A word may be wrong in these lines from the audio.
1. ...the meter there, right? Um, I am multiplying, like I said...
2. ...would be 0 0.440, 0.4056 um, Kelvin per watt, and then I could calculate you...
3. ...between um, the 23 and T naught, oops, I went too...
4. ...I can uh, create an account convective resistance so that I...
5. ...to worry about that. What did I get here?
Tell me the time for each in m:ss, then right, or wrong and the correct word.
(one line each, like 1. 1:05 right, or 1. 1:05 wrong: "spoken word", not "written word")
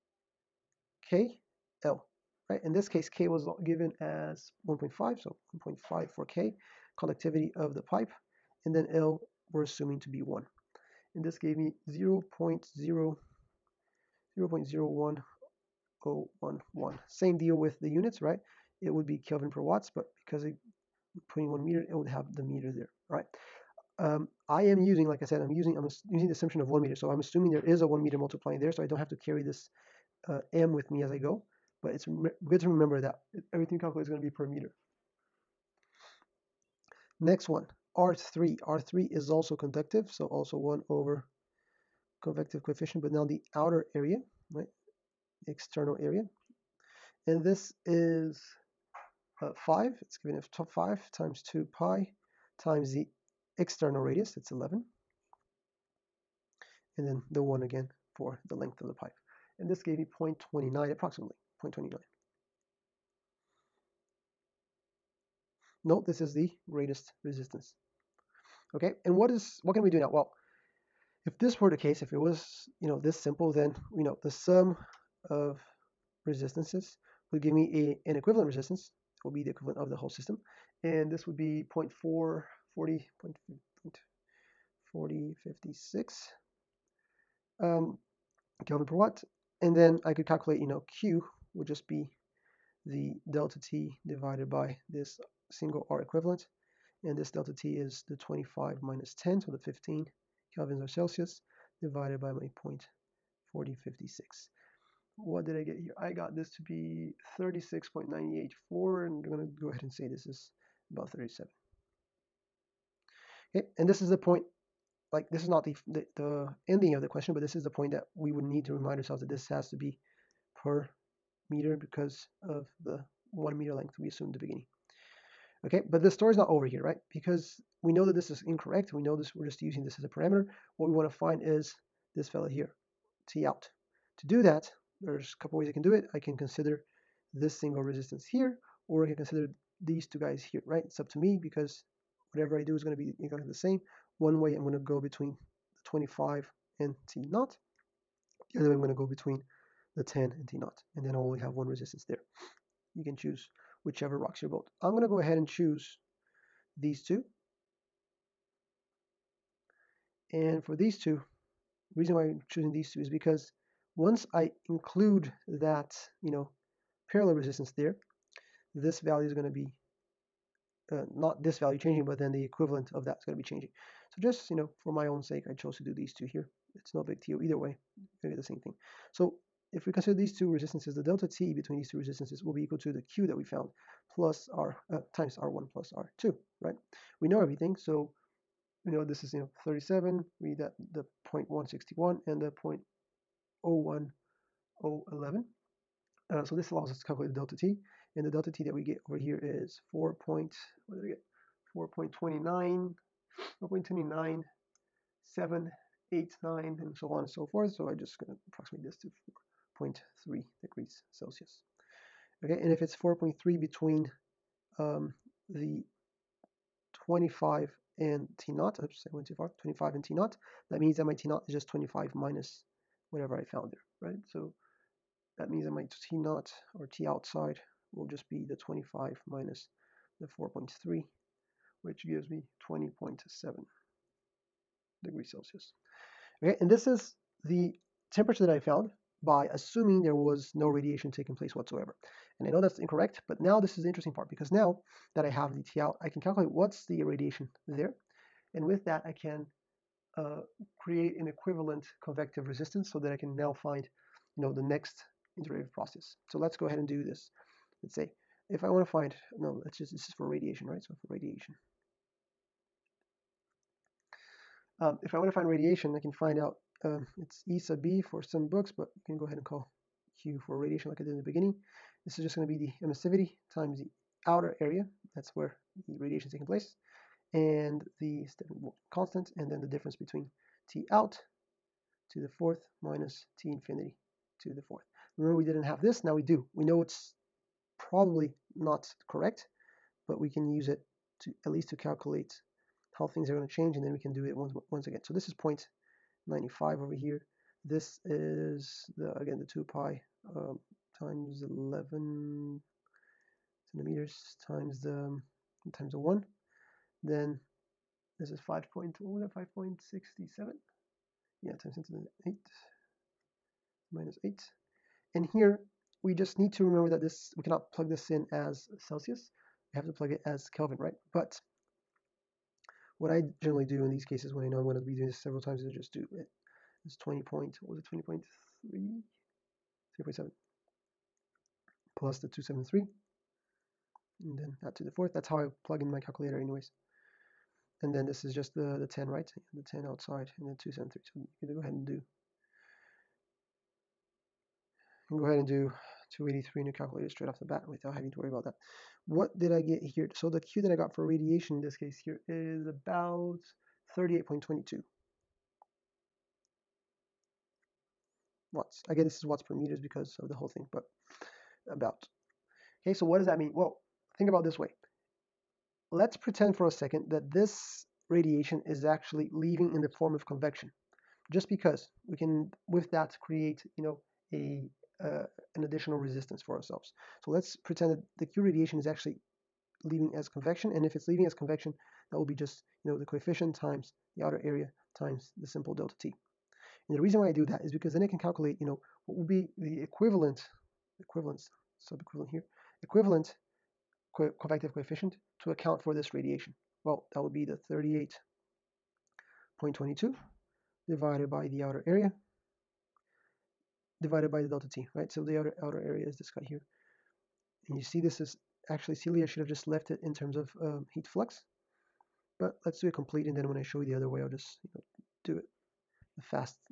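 1. 0:22 wrong: "using", not "multiplying"
2. 1:21 right
3. 3:33 wrong: "25", not "23"
4. 4:09 wrong: "equivalent", not "account"
5. 5:48 right.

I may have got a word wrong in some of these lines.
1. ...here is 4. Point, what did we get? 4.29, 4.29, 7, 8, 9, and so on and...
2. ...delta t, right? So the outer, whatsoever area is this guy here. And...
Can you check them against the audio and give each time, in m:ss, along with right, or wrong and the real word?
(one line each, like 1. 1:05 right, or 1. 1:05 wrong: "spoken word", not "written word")
1. 3:19 right
2. 6:44 wrong: "outer", not "whatsoever".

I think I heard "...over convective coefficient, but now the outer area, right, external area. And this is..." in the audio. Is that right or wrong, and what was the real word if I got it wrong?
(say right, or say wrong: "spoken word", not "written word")
right.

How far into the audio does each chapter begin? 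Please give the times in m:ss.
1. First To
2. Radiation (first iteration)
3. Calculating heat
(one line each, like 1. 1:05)
1. 2:05
2. 4:17
3. 1:11.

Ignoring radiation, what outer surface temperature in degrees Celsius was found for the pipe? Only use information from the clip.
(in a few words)
20.7.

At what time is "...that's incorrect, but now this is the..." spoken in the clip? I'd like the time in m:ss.
4:02.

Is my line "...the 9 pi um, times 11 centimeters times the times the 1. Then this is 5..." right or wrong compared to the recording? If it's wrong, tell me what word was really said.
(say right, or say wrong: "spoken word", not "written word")
wrong: "2", not "9".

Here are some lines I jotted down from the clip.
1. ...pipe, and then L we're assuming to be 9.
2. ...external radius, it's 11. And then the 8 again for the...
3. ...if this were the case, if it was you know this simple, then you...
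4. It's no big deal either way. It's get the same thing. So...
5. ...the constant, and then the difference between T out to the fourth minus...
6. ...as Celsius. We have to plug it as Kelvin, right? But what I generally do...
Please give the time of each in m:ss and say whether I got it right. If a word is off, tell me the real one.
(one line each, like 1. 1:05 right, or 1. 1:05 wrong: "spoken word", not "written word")
1. 0:07 wrong: "1", not "9"
2. 0:53 wrong: "1", not "8"
3. 1:11 right
4. 2:56 right
5. 4:37 right
6. 5:18 right.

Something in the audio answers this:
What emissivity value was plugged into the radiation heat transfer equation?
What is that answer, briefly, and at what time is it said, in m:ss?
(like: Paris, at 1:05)
0.95, at 4:55.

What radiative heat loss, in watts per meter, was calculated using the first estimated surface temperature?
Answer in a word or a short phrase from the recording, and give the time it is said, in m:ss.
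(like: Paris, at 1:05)
38.22 W, at 5:53.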